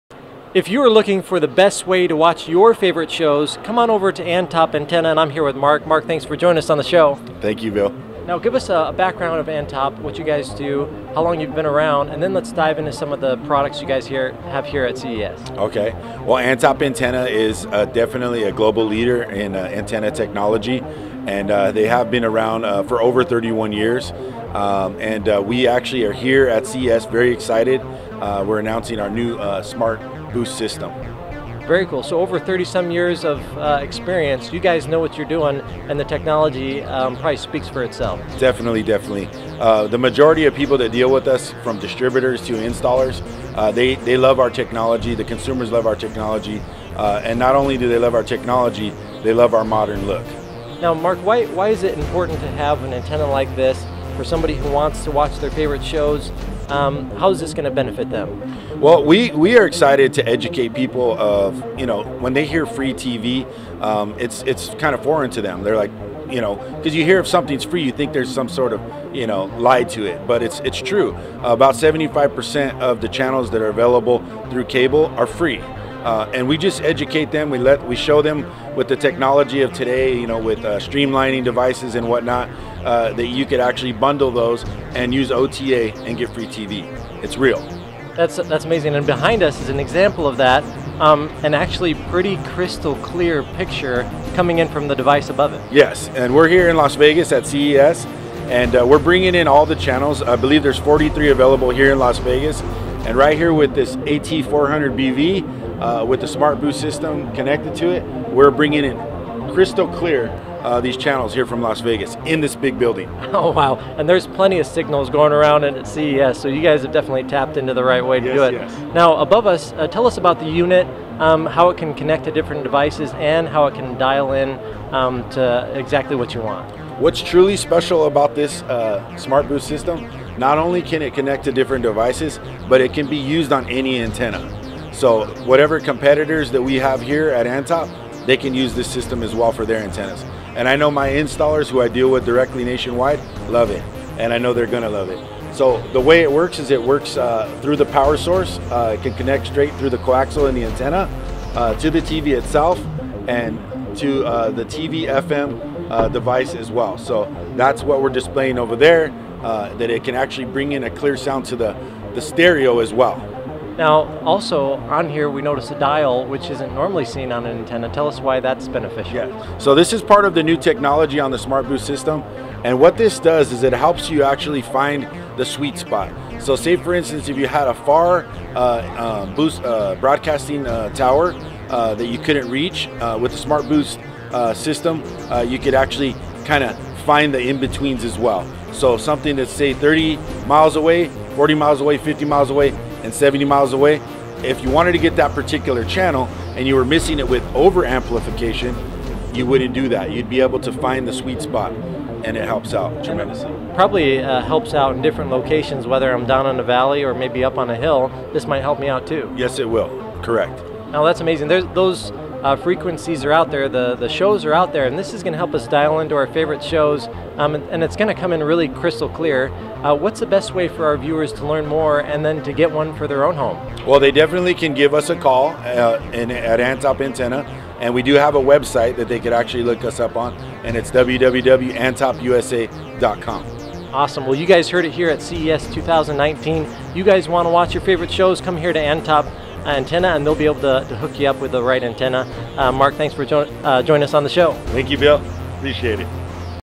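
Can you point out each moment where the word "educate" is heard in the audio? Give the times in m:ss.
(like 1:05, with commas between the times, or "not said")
1:00, 1:16.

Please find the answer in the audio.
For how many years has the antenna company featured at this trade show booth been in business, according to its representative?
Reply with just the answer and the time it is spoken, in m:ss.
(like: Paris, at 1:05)
over 31 years, at 0:23.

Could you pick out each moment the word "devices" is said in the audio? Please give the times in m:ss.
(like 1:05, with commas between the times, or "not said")
1:21, 1:34, 2:02, 2:11, 2:36.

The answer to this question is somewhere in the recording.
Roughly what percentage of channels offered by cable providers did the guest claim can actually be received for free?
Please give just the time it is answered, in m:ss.
1:11.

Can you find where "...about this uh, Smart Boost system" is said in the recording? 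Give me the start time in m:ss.
2:08.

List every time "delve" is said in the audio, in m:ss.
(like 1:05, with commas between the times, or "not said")
not said.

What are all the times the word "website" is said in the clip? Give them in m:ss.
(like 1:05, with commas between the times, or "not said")
3:48.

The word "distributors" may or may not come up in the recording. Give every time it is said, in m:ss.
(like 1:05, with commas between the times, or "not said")
0:41.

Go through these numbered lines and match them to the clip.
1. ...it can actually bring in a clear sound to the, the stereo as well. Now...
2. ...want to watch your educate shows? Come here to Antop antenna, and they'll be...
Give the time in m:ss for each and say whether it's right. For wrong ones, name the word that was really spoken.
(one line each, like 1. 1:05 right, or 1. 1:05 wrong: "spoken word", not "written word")
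1. 2:39 right
2. 3:57 wrong: "favorite", not "educate".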